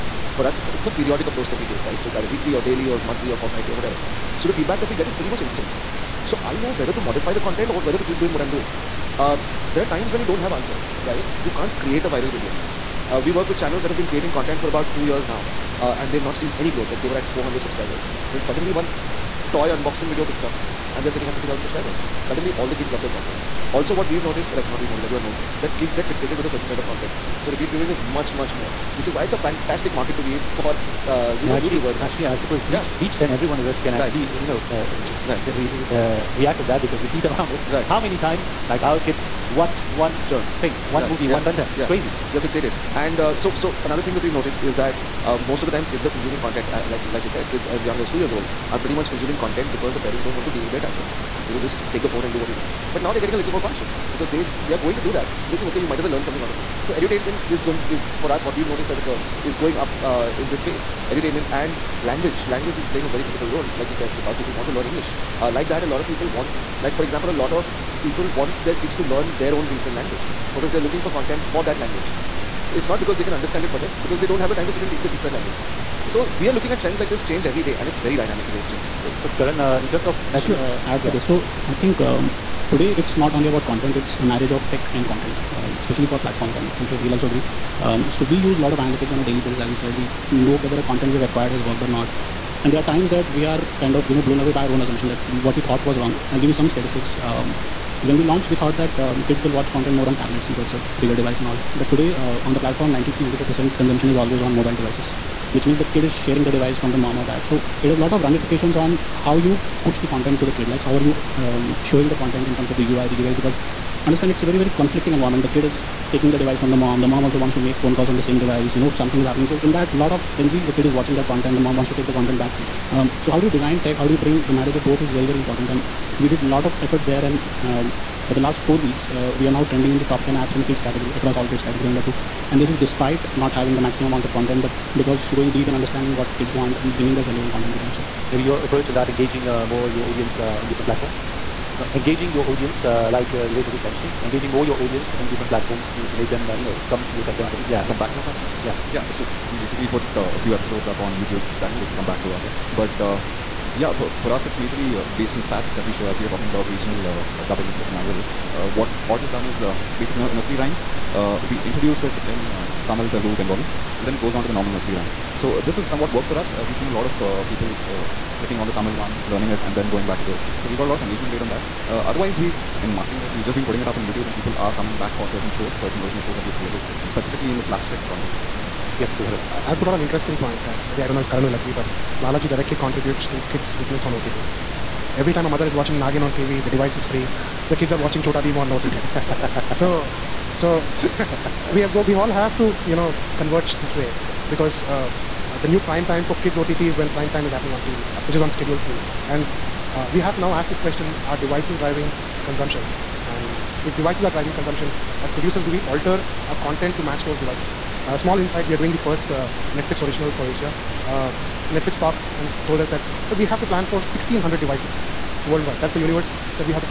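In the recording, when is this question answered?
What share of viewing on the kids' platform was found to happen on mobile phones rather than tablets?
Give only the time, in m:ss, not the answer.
1:42.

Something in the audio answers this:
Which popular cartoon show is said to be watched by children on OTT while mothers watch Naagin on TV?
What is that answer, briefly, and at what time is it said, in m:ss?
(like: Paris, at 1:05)
Chota Bheem, at 3:08.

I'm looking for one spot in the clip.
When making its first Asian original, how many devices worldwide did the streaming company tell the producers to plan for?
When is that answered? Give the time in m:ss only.
3:33.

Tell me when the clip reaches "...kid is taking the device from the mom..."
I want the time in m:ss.
1:55.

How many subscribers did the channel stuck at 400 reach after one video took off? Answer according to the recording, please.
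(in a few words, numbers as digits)
50,000.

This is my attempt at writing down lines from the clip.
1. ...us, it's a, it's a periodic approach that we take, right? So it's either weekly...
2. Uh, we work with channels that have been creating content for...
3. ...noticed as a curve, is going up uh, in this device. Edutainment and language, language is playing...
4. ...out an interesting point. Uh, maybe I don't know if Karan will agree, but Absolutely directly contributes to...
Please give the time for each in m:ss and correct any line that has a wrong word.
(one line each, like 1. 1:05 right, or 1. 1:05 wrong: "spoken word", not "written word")
1. 0:00 right
2. 0:13 right
3. 0:58 wrong: "space", not "device"
4. 2:59 wrong: "Balaji", not "Absolutely".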